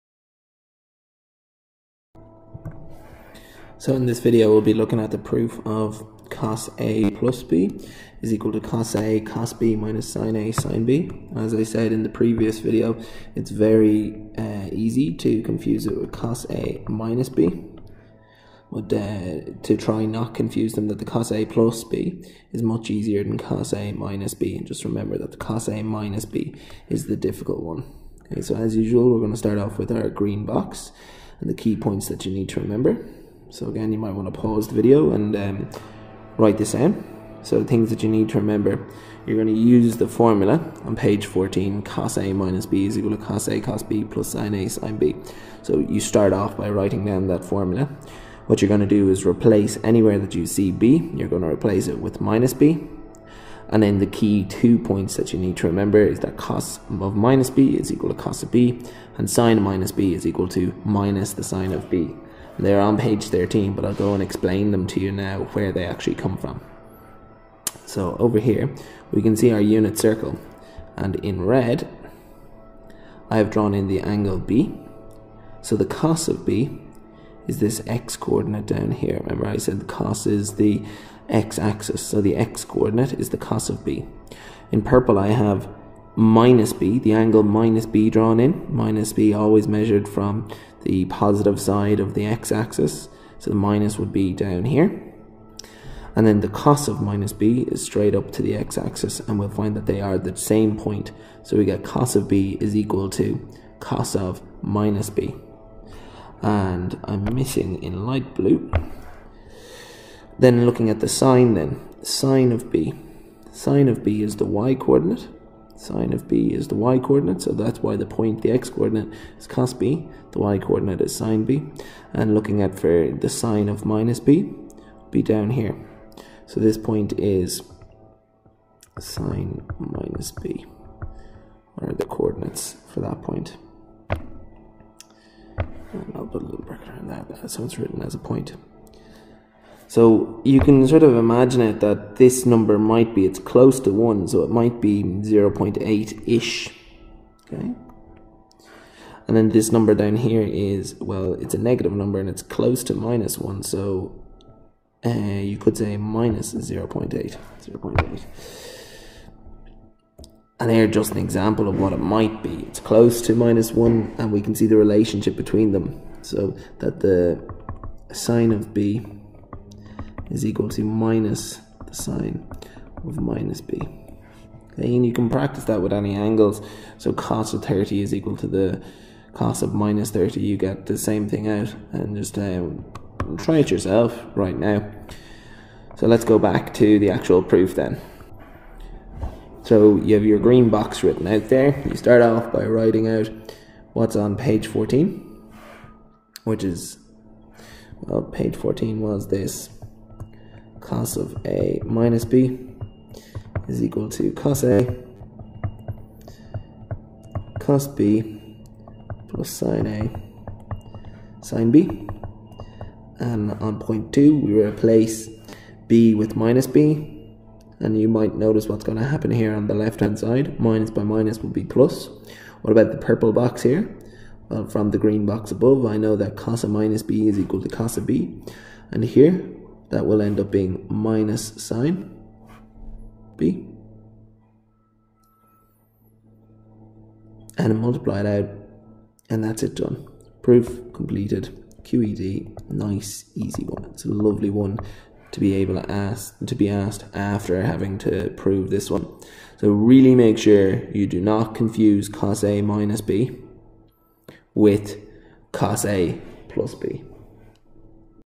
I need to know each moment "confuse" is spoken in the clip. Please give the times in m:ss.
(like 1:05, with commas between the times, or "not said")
0:15, 0:20, 4:11.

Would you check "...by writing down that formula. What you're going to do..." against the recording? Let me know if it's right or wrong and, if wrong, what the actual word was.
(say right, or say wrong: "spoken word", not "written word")
right.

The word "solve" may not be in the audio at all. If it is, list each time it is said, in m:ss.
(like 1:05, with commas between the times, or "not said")
not said.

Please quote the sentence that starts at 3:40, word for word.
Minus by minus will be plus.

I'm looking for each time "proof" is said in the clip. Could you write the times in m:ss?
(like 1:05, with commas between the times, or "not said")
0:05, 3:07, 4:00.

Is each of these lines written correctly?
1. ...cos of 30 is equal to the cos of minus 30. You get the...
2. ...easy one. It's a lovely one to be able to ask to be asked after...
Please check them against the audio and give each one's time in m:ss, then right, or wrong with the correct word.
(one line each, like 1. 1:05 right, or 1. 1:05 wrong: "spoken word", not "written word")
1. 2:57 right
2. 4:03 right.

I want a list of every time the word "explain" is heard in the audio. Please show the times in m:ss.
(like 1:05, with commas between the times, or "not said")
1:04.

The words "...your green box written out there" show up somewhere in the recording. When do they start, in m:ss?
3:10.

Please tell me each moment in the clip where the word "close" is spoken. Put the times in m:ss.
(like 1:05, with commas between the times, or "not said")
2:23, 2:32, 2:42.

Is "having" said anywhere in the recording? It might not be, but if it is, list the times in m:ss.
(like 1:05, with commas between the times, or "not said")
4:07.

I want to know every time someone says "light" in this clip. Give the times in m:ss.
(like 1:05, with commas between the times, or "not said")
1:48.